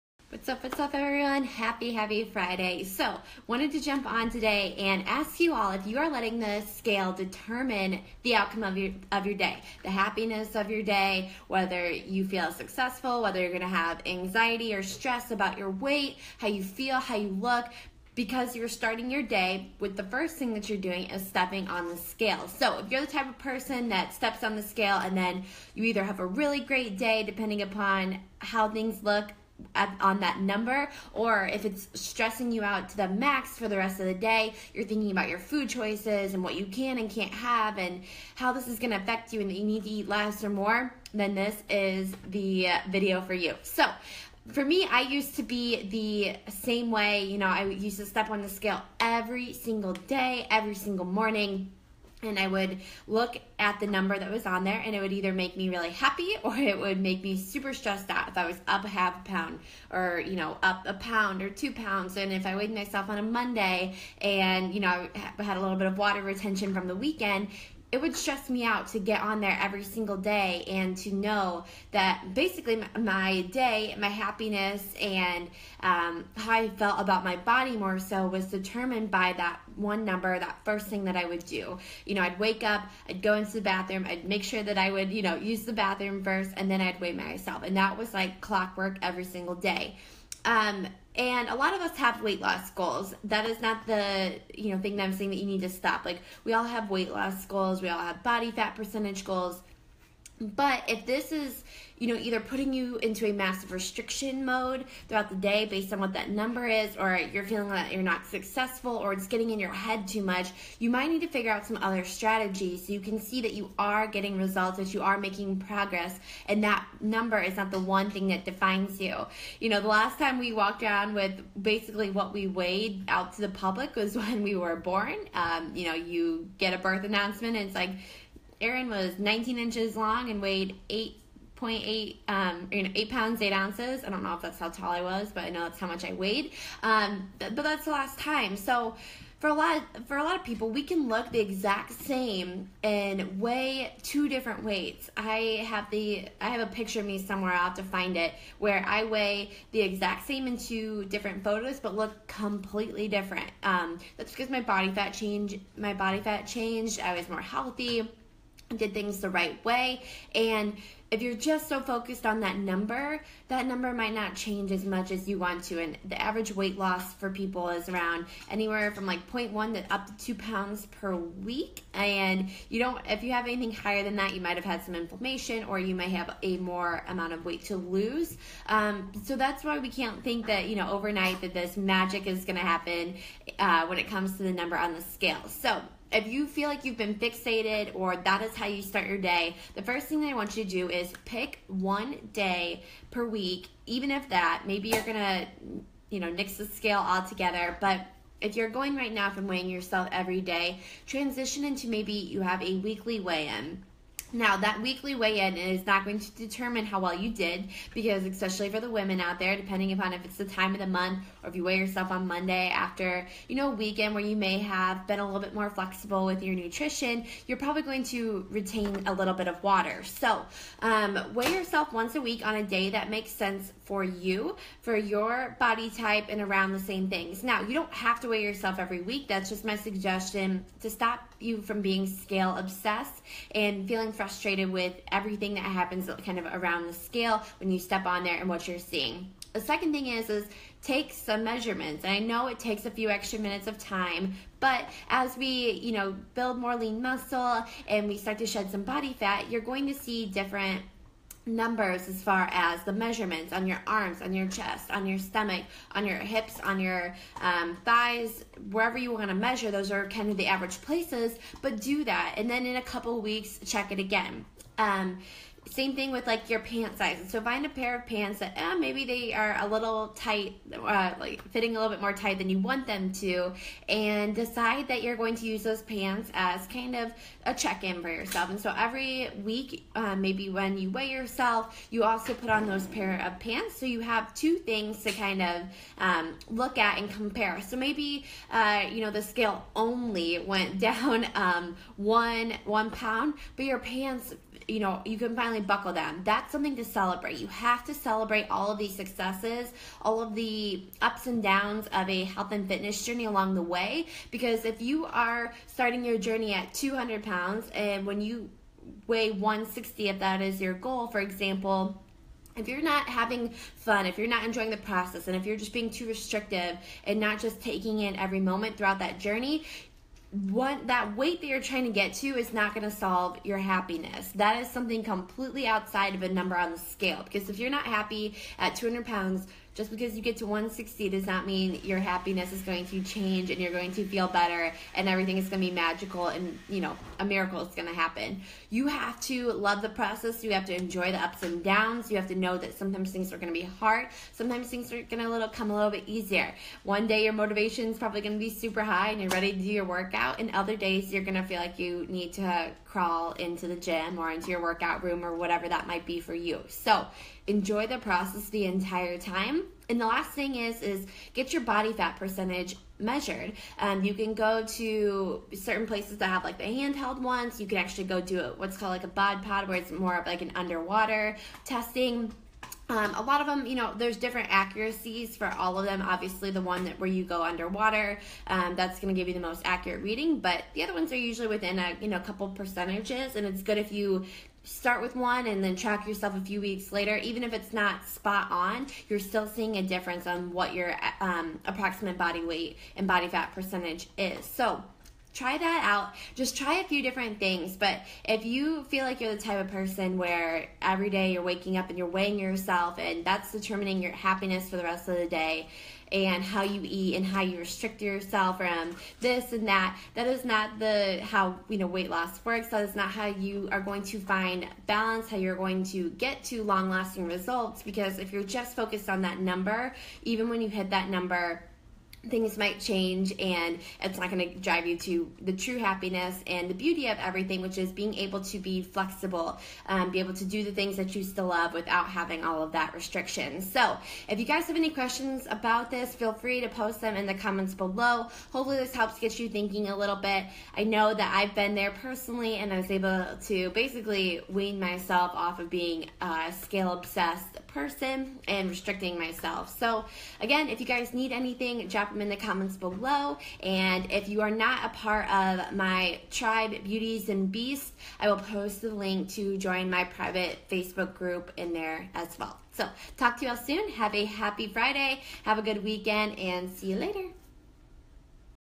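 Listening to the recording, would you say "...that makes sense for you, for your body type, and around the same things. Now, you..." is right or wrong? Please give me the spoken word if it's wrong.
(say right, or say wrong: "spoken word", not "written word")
right.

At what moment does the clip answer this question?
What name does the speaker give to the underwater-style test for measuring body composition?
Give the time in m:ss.
6:09.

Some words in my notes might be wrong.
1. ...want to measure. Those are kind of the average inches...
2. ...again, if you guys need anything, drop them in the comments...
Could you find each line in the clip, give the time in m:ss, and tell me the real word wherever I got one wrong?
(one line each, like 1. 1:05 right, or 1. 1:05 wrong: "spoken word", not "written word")
1. 4:19 wrong: "places", not "inches"
2. 7:30 right.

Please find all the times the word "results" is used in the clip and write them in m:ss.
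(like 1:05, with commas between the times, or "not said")
1:54, 6:57.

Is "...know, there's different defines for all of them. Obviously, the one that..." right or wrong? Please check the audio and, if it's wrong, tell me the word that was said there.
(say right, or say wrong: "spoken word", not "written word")
wrong: "accuracies", not "defines".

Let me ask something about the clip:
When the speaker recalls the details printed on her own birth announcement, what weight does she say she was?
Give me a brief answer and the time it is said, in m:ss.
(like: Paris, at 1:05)
8 pounds, 8 ounces, at 2:12.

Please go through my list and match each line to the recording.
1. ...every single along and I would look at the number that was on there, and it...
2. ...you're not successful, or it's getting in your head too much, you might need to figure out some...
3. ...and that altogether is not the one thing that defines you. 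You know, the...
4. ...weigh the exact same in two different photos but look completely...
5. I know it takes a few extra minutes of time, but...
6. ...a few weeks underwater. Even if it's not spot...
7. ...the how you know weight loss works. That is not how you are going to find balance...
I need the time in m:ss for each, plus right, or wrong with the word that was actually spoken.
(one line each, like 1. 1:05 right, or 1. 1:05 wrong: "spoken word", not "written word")
1. 0:50 wrong: "morning", not "along"
2. 1:47 right
3. 1:56 wrong: "number", not "altogether"
4. 2:29 right
5. 4:02 right
6. 6:26 wrong: "later", not "underwater"
7. 6:50 right.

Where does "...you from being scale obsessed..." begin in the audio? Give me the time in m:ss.
3:51.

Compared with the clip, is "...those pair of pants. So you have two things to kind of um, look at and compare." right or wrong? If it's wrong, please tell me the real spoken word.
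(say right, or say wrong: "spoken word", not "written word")
right.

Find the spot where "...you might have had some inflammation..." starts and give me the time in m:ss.
2:54.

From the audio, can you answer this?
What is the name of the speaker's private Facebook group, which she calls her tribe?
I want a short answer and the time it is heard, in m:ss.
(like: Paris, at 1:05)
Beauties and Beasts, at 7:36.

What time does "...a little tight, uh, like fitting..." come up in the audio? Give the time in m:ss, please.
4:29.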